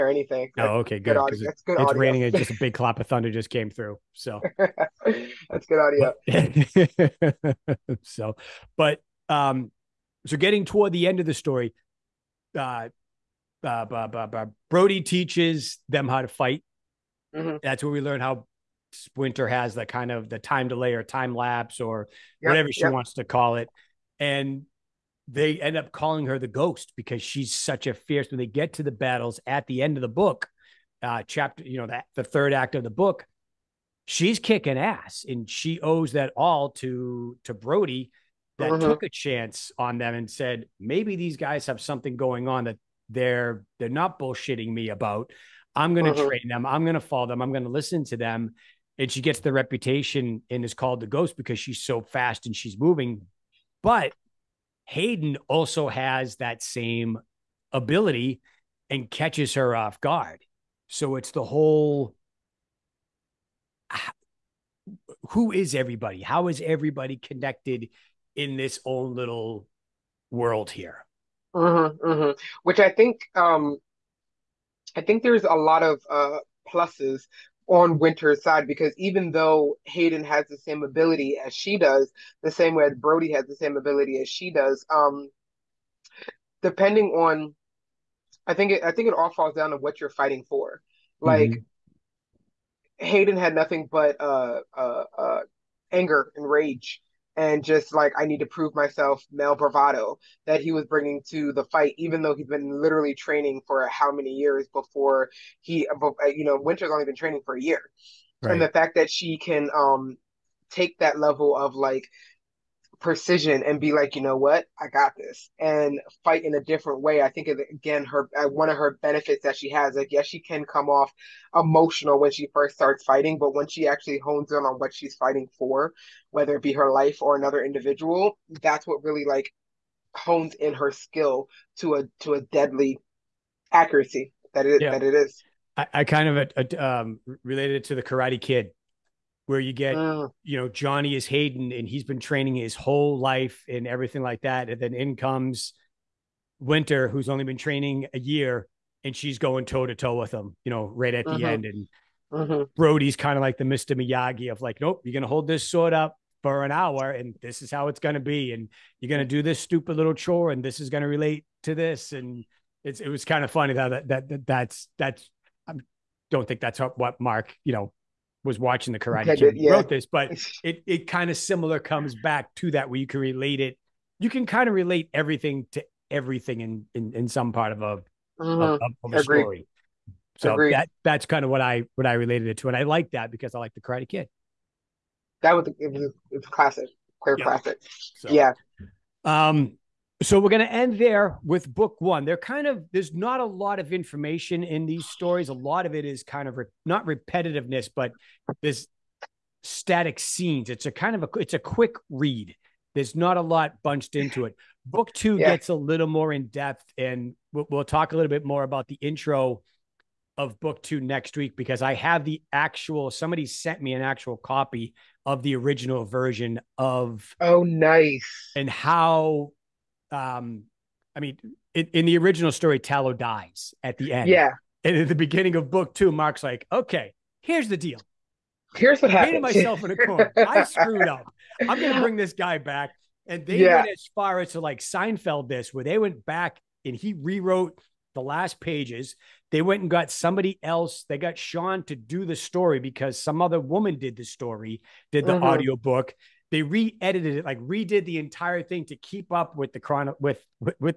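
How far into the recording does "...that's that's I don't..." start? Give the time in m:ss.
2:44.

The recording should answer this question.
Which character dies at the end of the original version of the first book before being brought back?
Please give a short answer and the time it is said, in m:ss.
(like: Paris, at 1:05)
Tallow, at 3:42.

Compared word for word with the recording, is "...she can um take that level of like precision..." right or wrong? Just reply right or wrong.
right.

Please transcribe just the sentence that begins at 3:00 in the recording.
that that's kind of what I what I related it to, and I like that because I like the Karate Kid.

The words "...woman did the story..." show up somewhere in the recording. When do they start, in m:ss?
4:03.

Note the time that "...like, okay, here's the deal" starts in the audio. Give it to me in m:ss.
3:46.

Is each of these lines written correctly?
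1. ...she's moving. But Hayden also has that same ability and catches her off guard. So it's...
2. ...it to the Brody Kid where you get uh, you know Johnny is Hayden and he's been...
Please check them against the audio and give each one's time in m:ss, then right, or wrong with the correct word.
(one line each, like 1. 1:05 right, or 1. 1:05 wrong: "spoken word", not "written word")
1. 0:52 right
2. 2:17 wrong: "Karate", not "Brody".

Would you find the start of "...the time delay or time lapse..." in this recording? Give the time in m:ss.
0:20.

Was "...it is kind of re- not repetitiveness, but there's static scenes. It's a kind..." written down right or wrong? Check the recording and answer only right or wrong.
right.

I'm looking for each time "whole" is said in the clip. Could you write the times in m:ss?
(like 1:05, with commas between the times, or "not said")
1:01, 2:22.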